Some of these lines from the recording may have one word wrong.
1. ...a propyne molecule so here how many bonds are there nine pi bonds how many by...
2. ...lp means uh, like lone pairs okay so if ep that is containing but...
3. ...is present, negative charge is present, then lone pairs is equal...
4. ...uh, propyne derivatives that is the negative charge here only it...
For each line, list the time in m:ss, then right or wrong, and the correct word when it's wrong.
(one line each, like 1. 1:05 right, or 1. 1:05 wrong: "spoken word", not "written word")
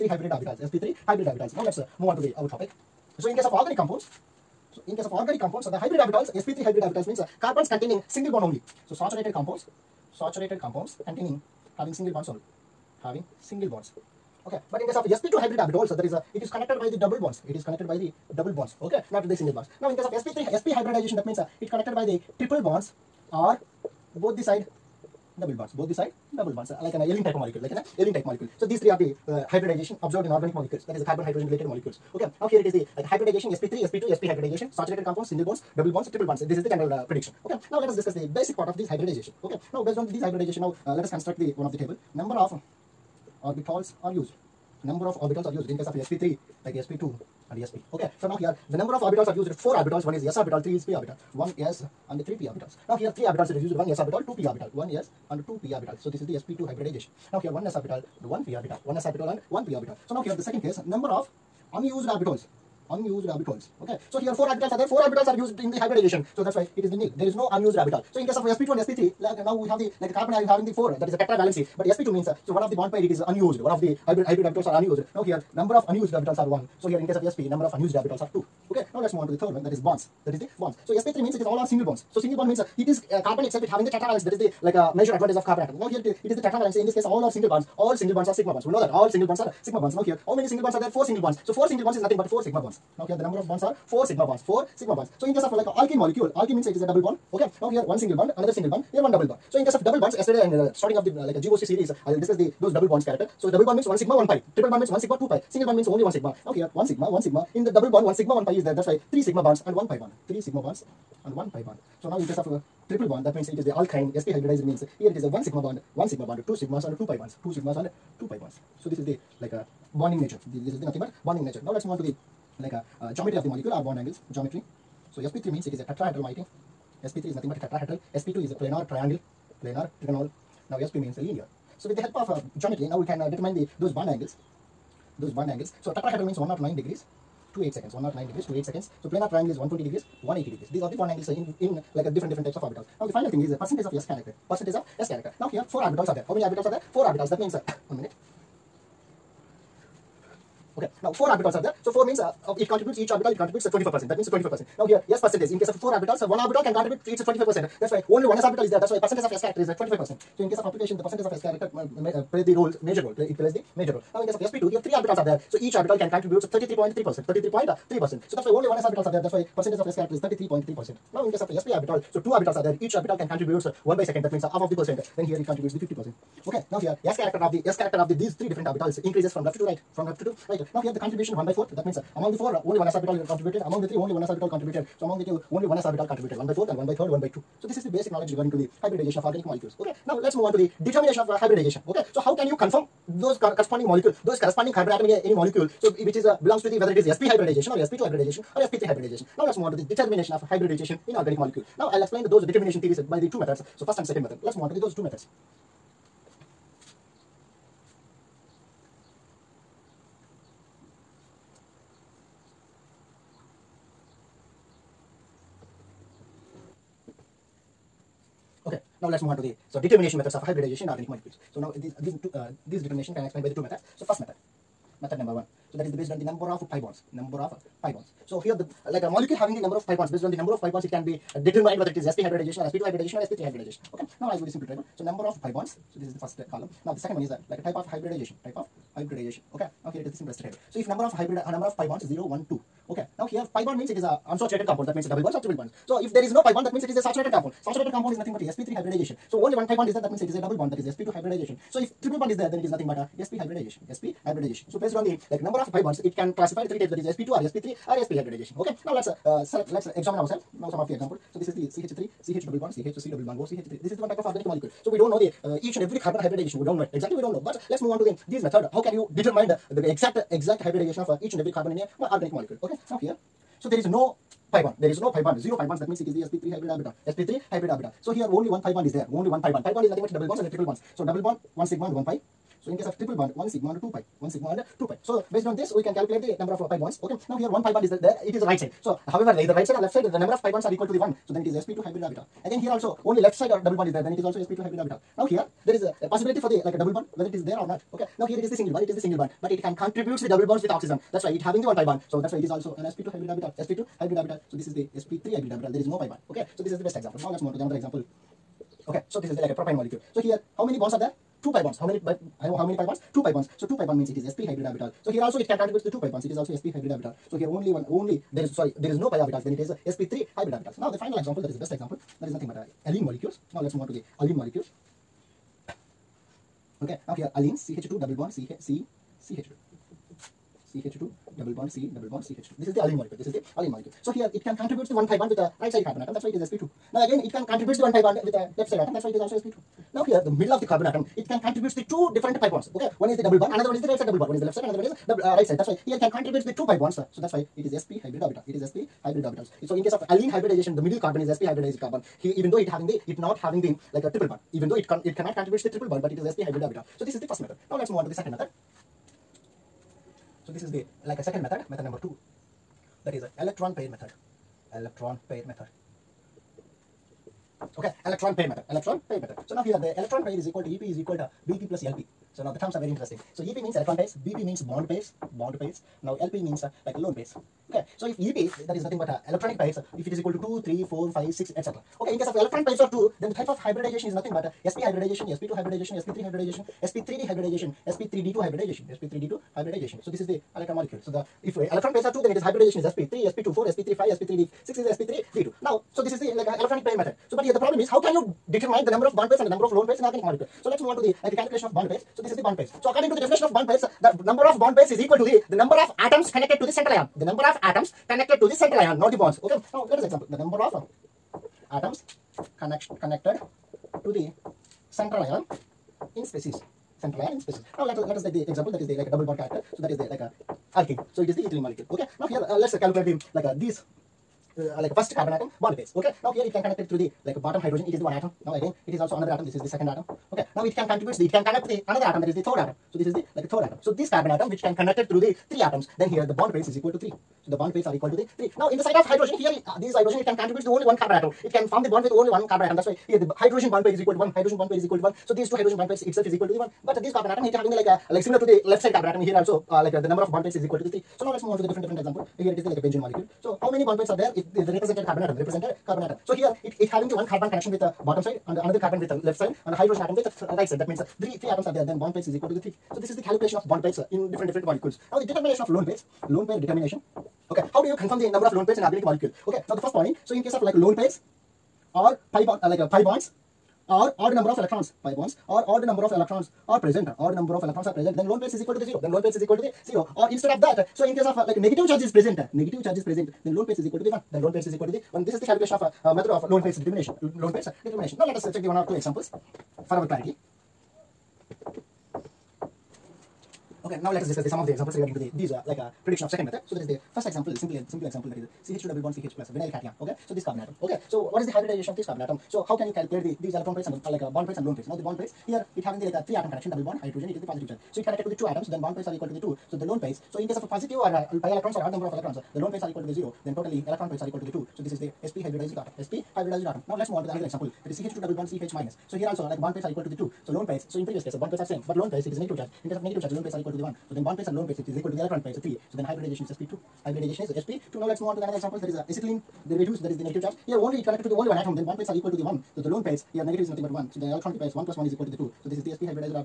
1. 5:09 wrong: "two", not "nine"
2. 6:16 wrong: "nothing", not "containing"
3. 8:02 right
4. 8:48 wrong: "acetylene", not "propyne".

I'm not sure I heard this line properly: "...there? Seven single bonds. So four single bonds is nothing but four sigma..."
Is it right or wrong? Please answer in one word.
wrong.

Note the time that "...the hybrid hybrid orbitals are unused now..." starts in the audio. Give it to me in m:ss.
1:13.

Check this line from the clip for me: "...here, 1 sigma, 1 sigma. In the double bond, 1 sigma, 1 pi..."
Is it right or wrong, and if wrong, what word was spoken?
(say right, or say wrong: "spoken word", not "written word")
right.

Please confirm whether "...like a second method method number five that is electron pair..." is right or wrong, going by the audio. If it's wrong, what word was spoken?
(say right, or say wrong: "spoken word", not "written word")
wrong: "two", not "five".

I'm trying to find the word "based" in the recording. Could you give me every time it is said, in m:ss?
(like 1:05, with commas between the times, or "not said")
0:39, 3:45, 3:50, 4:14, 4:45.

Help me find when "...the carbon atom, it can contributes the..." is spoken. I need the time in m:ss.
5:40.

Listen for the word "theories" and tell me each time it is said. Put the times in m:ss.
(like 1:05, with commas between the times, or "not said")
3:22.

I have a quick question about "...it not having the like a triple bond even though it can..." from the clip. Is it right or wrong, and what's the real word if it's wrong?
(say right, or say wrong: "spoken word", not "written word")
right.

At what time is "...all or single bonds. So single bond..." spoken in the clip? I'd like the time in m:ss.
1:21.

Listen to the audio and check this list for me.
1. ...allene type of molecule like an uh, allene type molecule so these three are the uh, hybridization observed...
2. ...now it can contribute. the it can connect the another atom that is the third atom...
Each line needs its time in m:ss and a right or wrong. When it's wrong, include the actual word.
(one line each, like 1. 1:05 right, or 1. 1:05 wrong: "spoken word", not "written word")
1. 0:27 right
2. 7:10 right.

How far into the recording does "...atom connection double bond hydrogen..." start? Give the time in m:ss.
8:26.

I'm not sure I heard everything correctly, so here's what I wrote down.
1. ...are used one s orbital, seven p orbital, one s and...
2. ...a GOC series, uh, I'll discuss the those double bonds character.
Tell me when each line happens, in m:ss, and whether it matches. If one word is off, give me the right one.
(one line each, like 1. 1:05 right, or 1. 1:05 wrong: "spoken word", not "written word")
1. 0:53 wrong: "two", not "seven"
2. 1:41 right.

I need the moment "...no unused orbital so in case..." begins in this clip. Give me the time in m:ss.
1:07.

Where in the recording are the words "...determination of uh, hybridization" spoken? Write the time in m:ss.
3:10.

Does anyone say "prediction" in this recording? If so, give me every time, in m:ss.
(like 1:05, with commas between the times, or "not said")
0:37, 8:16.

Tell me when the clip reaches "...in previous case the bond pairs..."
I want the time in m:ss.
8:40.